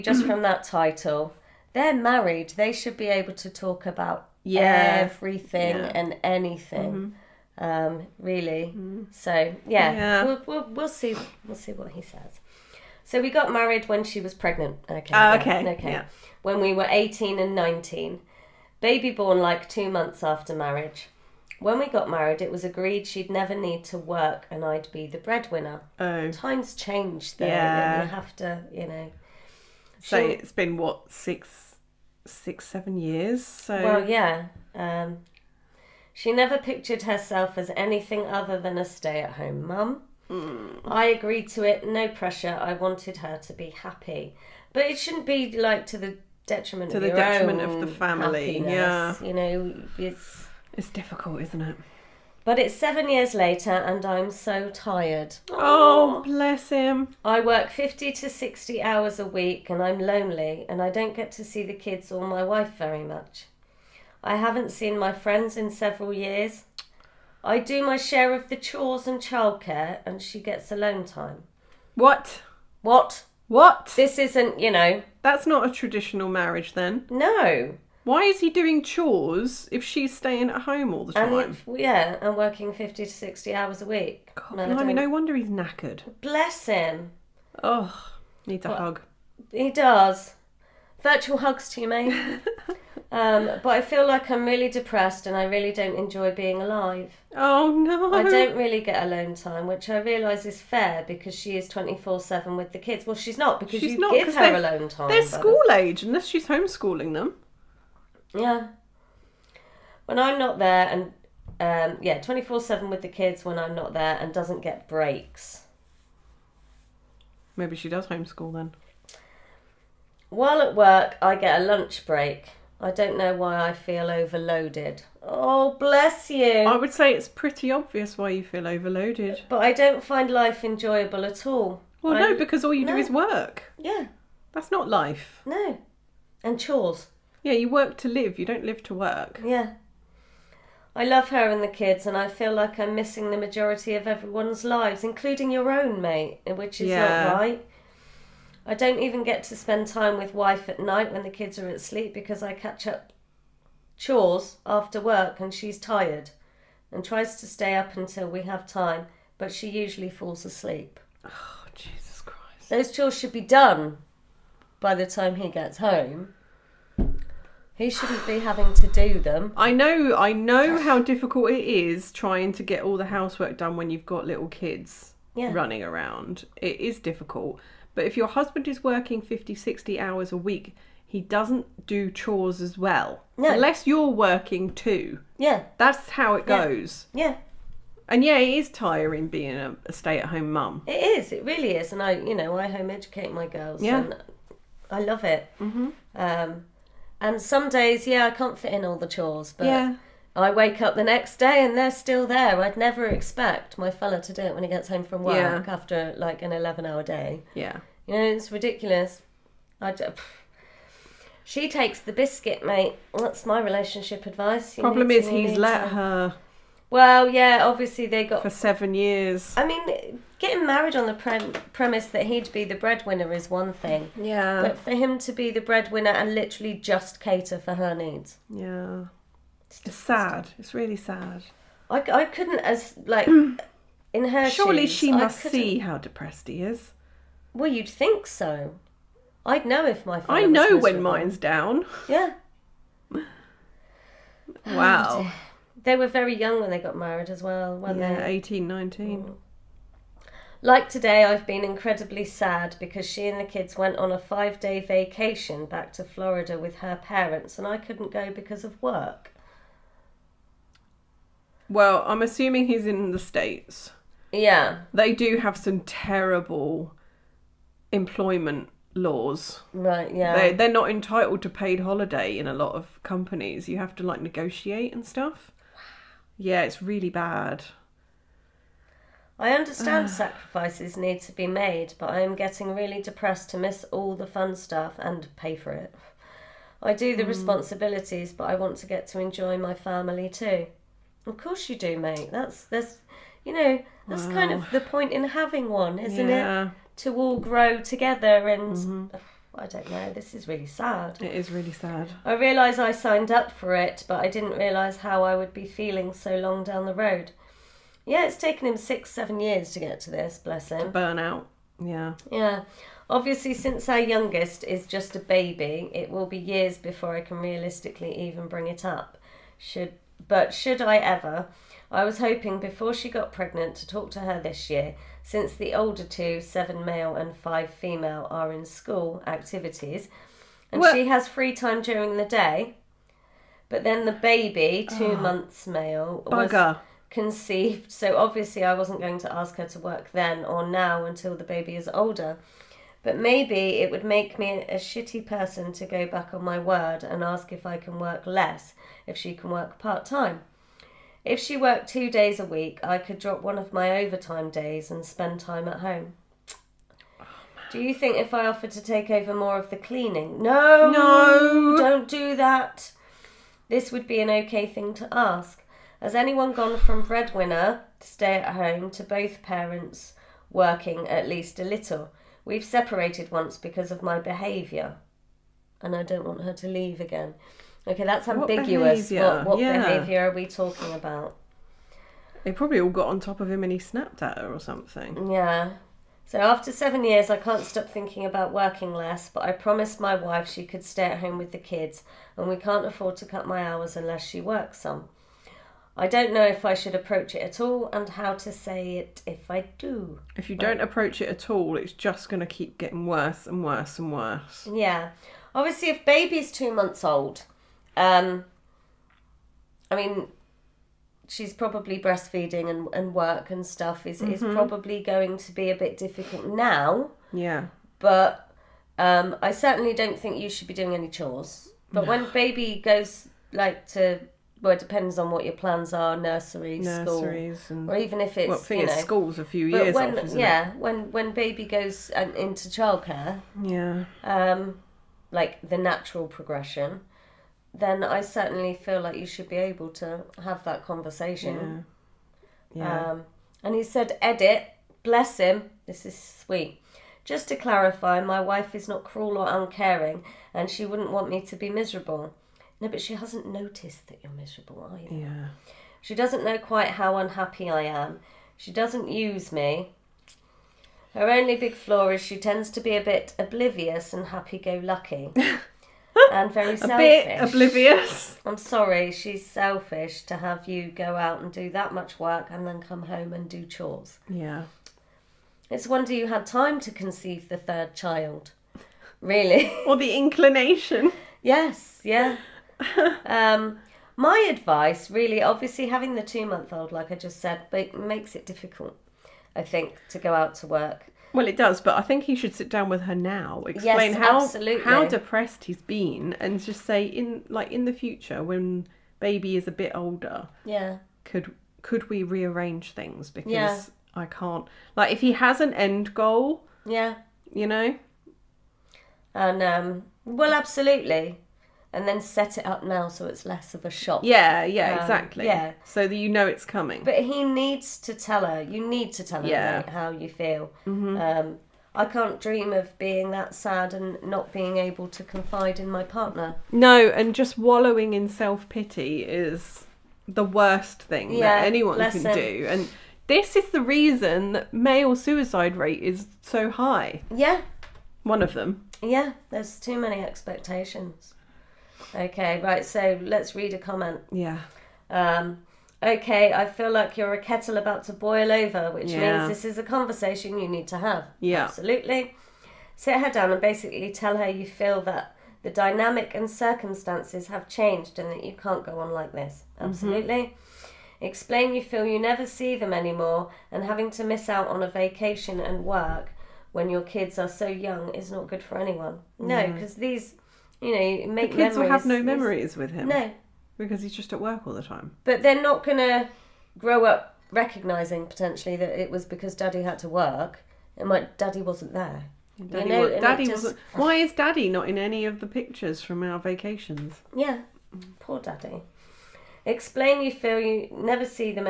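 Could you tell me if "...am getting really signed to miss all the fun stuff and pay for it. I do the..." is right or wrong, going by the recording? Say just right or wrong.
wrong.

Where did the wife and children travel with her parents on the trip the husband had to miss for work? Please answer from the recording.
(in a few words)
Florida.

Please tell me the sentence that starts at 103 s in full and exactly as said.
Well, she's not because she's you not, give her alone time.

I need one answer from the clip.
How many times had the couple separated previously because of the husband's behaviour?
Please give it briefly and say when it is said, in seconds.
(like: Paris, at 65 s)
Once, at 373 s.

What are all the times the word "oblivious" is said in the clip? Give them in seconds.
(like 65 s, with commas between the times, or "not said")
463 s, 467 s.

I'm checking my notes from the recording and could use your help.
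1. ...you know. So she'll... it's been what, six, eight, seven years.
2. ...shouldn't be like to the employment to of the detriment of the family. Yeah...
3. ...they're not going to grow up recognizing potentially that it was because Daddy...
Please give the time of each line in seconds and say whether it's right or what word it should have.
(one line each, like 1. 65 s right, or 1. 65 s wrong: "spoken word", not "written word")
1. 28 s wrong: "six", not "eight"
2. 44 s wrong: "detriment", not "employment"
3. 575 s right.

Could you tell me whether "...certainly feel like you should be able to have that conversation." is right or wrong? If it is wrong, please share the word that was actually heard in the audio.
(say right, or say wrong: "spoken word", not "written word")
right.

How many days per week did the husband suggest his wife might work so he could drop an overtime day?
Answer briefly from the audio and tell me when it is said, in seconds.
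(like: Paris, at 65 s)
2, at 351 s.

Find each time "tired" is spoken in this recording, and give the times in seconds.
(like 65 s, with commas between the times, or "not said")
54 s, 155 s.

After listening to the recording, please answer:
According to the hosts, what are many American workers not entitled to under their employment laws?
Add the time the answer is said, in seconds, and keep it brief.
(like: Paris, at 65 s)
Paid holiday, at 271 s.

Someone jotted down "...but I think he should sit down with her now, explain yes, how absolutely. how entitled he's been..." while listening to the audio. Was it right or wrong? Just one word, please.
wrong.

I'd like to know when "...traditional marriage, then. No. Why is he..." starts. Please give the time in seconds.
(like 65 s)
75 s.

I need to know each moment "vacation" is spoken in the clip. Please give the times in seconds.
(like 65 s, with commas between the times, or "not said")
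254 s, 564 s, 586 s.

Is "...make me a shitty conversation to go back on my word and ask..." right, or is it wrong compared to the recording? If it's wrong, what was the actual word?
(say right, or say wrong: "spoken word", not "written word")
wrong: "person", not "conversation".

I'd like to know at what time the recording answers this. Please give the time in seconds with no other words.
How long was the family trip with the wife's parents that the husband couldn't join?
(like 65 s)
254 s.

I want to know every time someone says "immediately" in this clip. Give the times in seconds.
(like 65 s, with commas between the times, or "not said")
not said.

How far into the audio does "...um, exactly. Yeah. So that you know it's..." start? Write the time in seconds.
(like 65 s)
514 s.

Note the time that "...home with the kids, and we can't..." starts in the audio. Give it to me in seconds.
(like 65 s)
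391 s.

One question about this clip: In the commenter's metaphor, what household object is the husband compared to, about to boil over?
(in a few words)
A kettle.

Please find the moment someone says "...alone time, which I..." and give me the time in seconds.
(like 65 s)
99 s.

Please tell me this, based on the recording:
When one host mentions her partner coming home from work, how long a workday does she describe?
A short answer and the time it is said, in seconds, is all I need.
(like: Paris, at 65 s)
11 hours, at 206 s.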